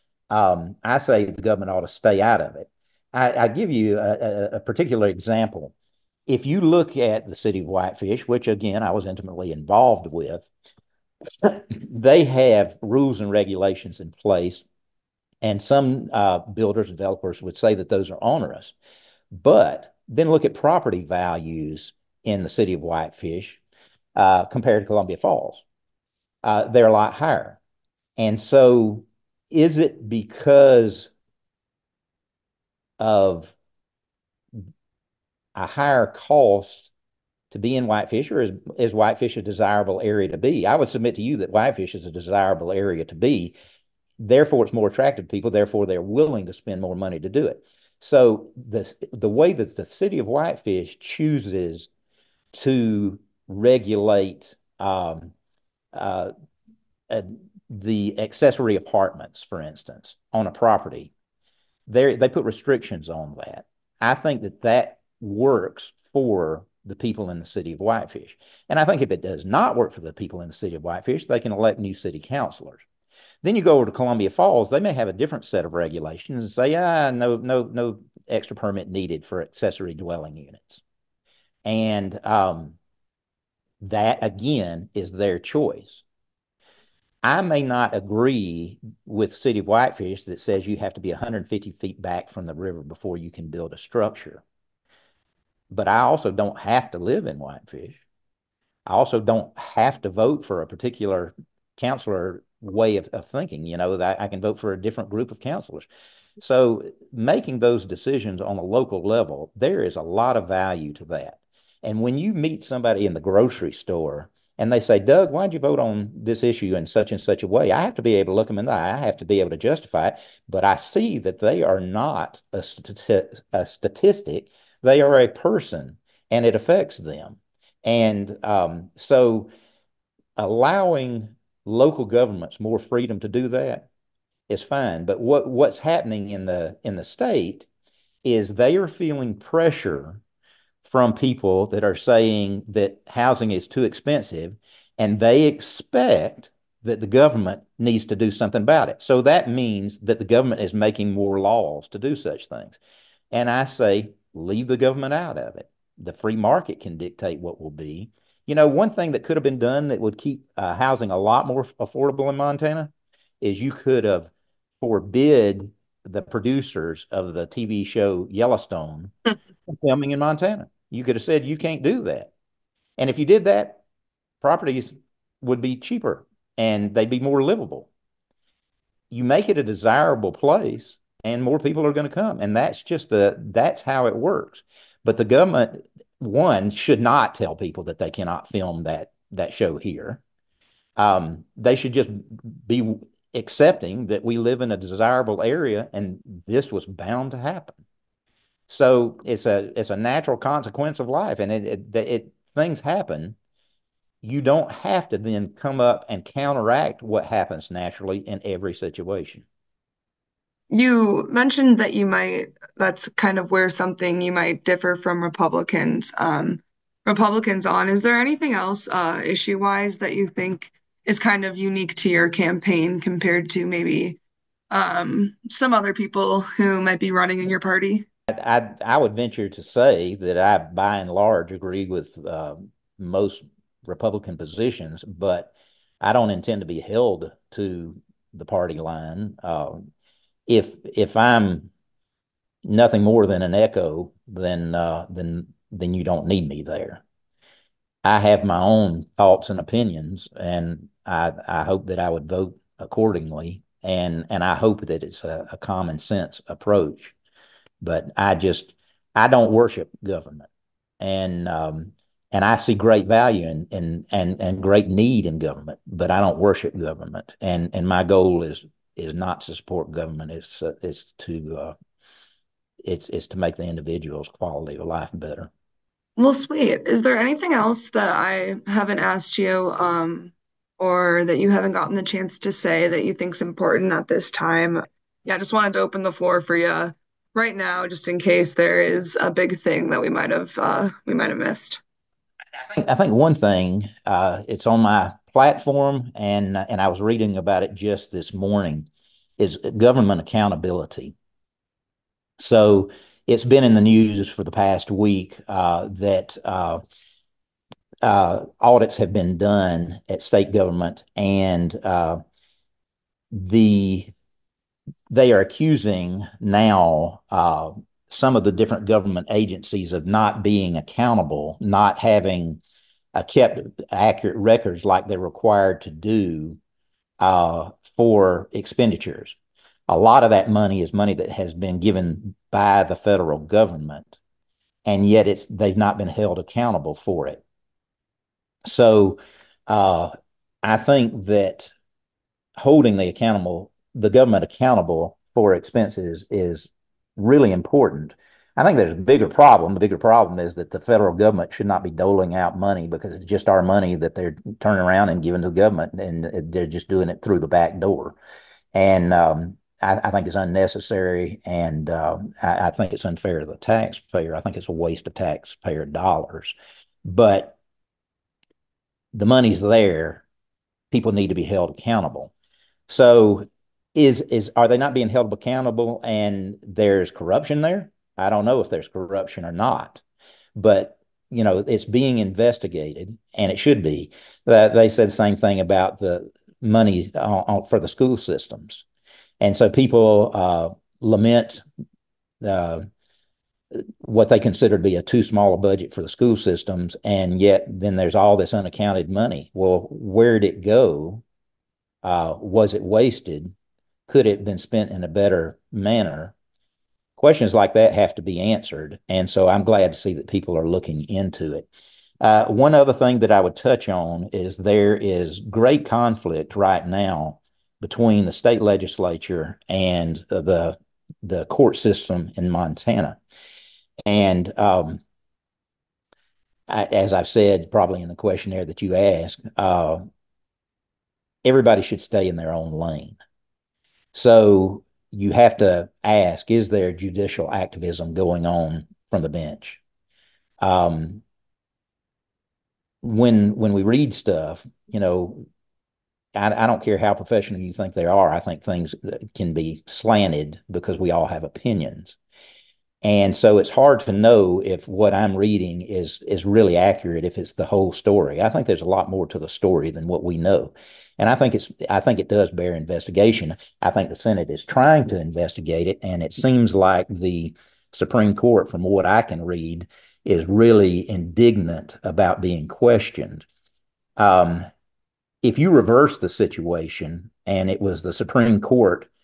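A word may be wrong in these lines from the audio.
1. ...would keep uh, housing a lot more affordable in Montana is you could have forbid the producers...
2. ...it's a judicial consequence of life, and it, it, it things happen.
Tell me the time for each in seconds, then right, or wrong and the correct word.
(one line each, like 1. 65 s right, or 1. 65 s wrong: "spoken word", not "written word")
1. 159 s right
2. 199 s wrong: "natural", not "judicial".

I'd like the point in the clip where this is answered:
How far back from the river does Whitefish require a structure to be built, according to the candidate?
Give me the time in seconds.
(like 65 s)
91 s.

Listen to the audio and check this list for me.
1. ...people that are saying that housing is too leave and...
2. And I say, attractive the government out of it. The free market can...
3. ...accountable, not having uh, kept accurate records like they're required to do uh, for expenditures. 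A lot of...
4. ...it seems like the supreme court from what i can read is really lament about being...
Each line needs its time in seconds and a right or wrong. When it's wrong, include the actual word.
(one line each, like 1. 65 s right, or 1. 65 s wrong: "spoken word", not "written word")
1. 141 s wrong: "expensive", not "leave"
2. 153 s wrong: "leave", not "attractive"
3. 320 s right
4. 466 s wrong: "indignant", not "lament".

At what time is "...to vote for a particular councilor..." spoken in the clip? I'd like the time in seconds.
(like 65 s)
100 s.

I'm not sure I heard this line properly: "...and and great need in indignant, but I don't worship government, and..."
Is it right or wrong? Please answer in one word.
wrong.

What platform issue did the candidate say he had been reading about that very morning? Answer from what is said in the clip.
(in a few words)
government accountability.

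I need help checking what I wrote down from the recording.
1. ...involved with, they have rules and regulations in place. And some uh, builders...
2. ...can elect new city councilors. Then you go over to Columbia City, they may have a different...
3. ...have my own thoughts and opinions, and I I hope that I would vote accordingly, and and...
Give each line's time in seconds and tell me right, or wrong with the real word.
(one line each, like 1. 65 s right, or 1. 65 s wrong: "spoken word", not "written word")
1. 9 s right
2. 71 s wrong: "Falls", not "City"
3. 248 s right.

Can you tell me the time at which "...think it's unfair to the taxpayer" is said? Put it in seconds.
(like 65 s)
362 s.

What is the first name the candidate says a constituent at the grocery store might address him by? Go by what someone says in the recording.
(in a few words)
Doug.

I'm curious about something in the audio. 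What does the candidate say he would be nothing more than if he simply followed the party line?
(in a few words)
an echo.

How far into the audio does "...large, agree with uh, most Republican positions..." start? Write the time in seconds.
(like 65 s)
231 s.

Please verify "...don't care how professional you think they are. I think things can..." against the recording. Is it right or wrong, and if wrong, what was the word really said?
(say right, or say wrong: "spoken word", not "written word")
right.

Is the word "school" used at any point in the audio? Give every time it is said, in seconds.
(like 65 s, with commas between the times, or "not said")
387 s, 396 s.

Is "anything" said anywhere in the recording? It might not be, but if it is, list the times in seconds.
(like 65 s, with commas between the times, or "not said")
218 s, 277 s.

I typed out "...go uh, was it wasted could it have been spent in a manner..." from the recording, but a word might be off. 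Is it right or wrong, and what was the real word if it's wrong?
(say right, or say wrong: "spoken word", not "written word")
wrong: "better", not "manner".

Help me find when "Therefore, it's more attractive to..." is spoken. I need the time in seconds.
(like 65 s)
44 s.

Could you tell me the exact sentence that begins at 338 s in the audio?
So, uh, I think that holding the accountable the government accountable for expenses is really important.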